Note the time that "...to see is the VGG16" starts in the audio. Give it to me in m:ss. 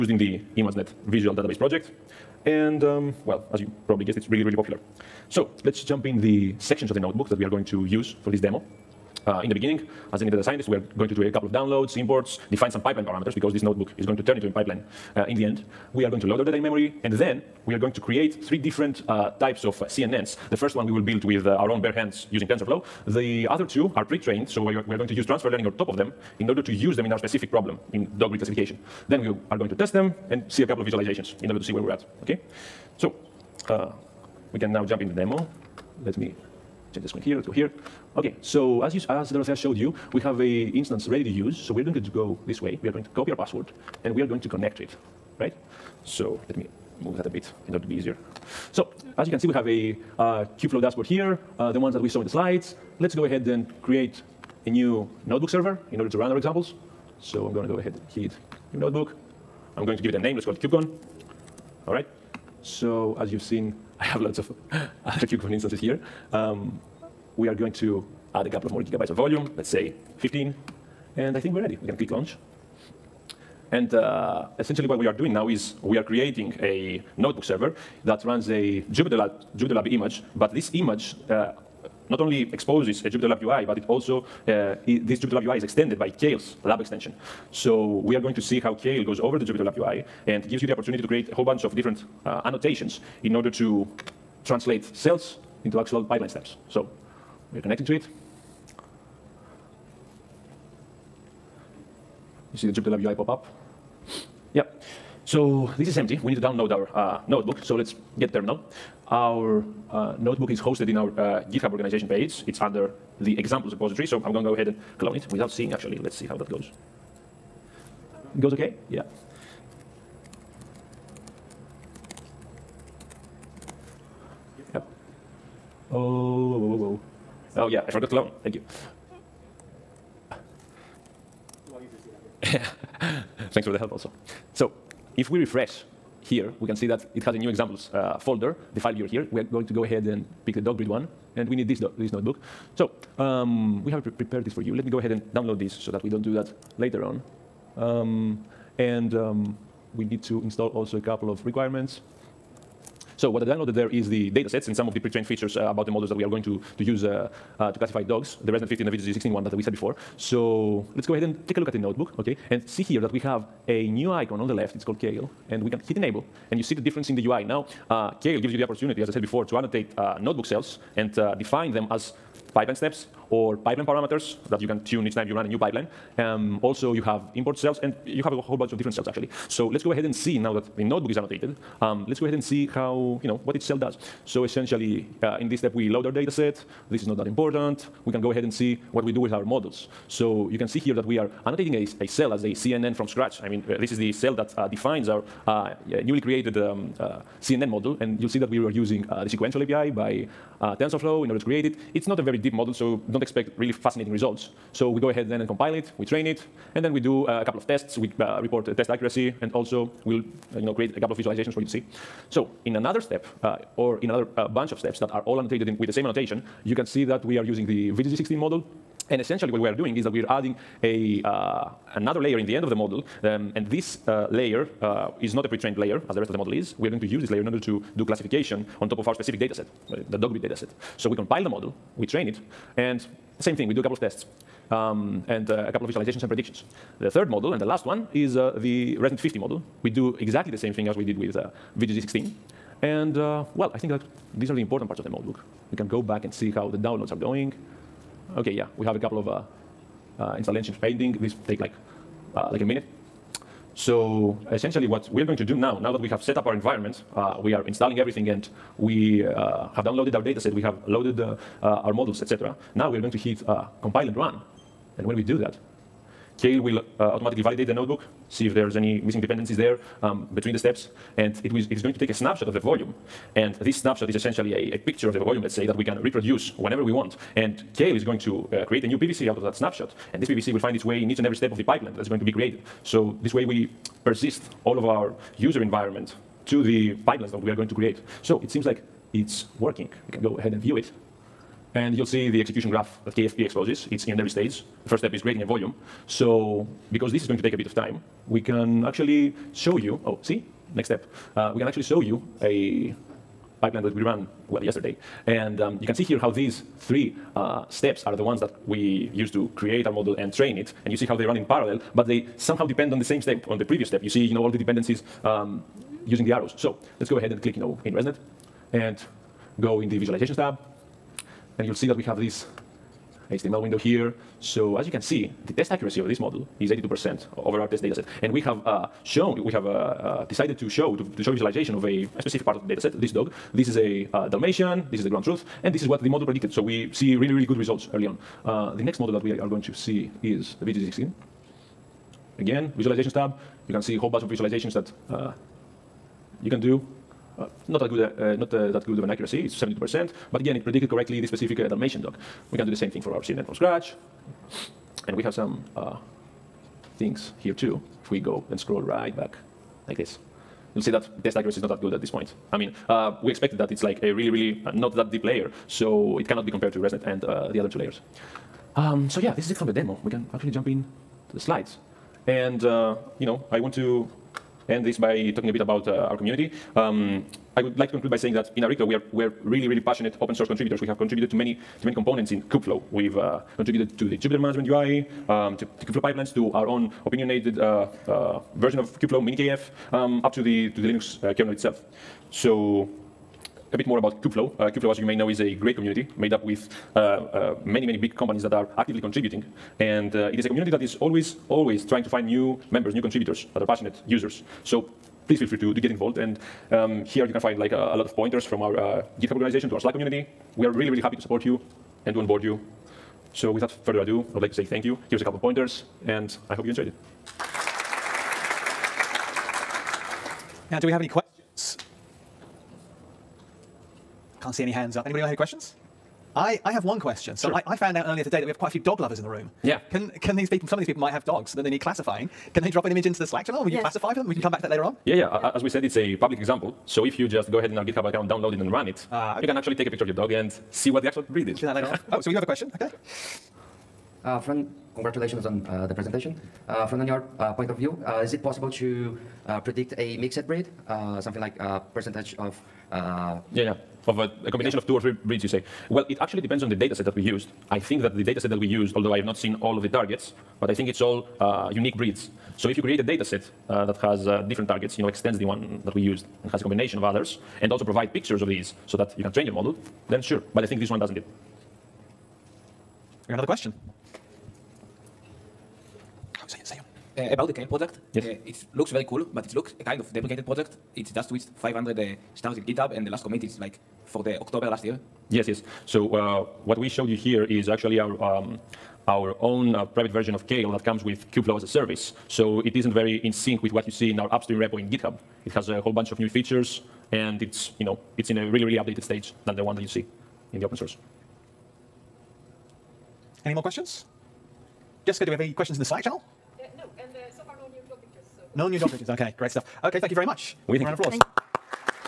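5:39.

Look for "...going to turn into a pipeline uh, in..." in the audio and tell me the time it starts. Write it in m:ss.
0:14.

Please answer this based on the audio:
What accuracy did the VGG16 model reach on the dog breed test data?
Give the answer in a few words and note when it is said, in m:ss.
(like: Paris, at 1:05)
72%, at 5:49.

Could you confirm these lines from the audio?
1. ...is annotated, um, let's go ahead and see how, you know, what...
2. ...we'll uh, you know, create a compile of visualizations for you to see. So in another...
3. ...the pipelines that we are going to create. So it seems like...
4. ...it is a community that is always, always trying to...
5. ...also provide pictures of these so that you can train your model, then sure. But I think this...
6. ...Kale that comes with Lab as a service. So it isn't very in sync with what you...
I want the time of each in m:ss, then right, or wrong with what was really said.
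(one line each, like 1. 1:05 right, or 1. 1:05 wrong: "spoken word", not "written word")
1. 3:01 right
2. 3:30 wrong: "couple", not "compile"
3. 4:46 right
4. 6:40 right
5. 7:47 right
6. 8:10 wrong: "Kubeflow", not "Lab".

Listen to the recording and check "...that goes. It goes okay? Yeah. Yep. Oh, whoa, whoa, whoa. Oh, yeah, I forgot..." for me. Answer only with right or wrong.
right.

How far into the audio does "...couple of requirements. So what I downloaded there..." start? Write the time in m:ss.
2:30.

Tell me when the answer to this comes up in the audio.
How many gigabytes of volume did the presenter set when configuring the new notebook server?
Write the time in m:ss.
1:10.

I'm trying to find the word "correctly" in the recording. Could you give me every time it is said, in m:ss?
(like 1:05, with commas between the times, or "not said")
5:50.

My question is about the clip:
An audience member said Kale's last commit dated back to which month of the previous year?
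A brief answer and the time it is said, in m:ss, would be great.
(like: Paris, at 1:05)
October, at 8:04.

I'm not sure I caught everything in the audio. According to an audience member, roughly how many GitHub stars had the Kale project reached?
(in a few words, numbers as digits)
500.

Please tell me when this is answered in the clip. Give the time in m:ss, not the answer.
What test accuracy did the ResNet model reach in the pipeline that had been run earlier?
5:26.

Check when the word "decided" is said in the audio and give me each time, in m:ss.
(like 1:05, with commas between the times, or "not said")
5:30.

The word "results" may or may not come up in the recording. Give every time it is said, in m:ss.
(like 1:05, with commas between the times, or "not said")
3:24, 5:37.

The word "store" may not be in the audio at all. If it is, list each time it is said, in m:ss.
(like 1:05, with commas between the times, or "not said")
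not said.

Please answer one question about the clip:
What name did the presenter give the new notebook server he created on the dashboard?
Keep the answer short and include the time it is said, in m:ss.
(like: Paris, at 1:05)
KubeCon, at 1:00.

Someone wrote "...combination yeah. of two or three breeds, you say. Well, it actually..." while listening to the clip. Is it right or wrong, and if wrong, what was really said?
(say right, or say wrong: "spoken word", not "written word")
right.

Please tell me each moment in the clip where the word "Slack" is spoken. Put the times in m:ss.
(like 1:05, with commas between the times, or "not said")
6:49, 7:13, 8:25.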